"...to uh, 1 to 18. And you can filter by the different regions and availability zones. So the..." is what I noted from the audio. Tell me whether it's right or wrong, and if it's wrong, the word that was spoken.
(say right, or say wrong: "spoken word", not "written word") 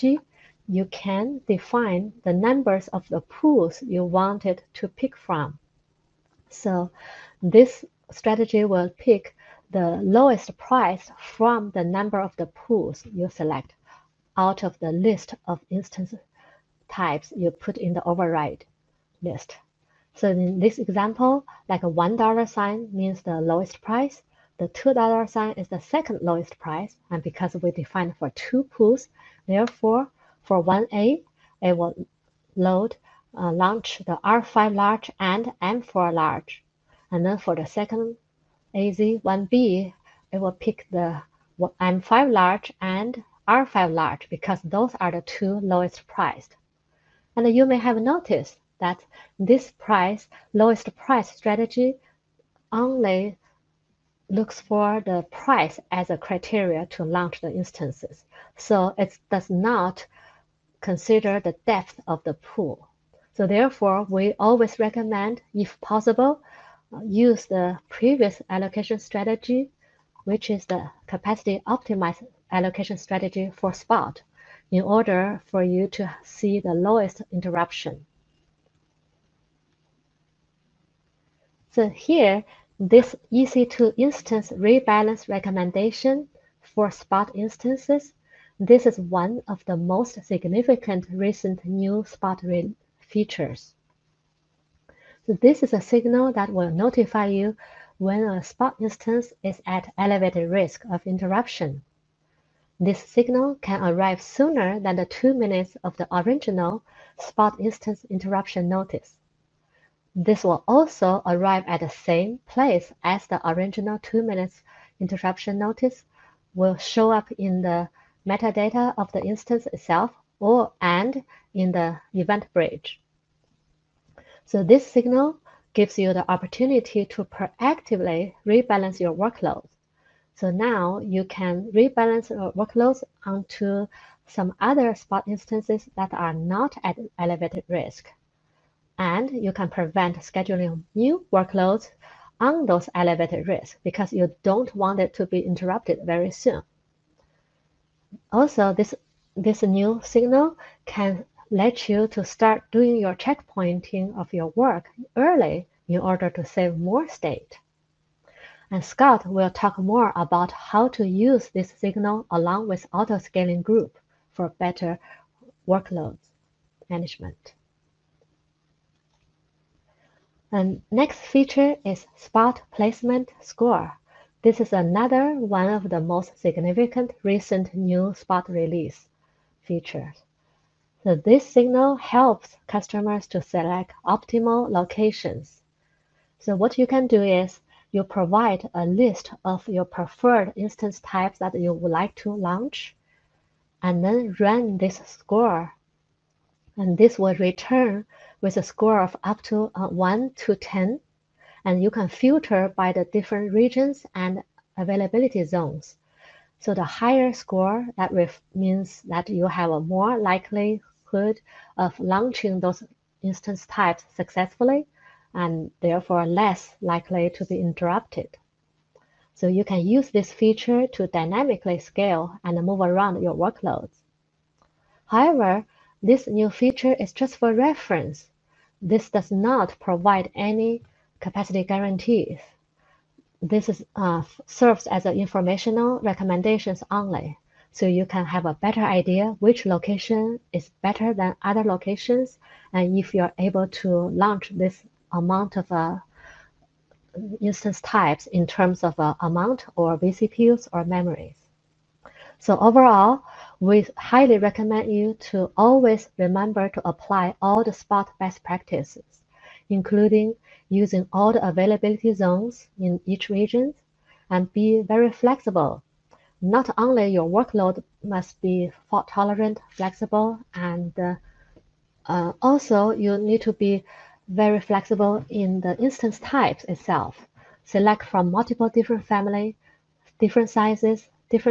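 wrong: "10", not "18".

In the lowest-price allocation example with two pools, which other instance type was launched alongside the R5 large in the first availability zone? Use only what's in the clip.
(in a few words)
M4 large.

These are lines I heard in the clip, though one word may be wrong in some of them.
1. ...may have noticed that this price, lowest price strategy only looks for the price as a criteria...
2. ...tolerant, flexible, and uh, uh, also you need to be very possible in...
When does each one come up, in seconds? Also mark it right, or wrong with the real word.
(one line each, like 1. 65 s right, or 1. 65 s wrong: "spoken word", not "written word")
1. 47 s right
2. 269 s wrong: "flexible", not "possible".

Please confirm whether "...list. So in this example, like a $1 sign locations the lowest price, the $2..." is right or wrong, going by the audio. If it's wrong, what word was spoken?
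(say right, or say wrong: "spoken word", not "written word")
wrong: "means", not "locations".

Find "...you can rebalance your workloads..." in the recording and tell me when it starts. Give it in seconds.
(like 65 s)
130 s.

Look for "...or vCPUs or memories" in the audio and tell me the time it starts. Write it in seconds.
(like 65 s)
249 s.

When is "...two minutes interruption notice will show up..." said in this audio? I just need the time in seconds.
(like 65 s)
114 s.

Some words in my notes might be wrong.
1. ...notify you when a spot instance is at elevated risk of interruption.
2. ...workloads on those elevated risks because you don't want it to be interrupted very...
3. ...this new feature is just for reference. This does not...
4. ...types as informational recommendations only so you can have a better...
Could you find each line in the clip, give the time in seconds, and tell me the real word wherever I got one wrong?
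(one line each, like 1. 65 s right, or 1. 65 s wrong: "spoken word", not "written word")
1. 96 s right
2. 141 s right
3. 225 s right
4. 234 s wrong: "serves", not "types".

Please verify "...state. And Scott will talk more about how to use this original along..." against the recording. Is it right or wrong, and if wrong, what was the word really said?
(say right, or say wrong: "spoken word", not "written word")
wrong: "signal", not "original".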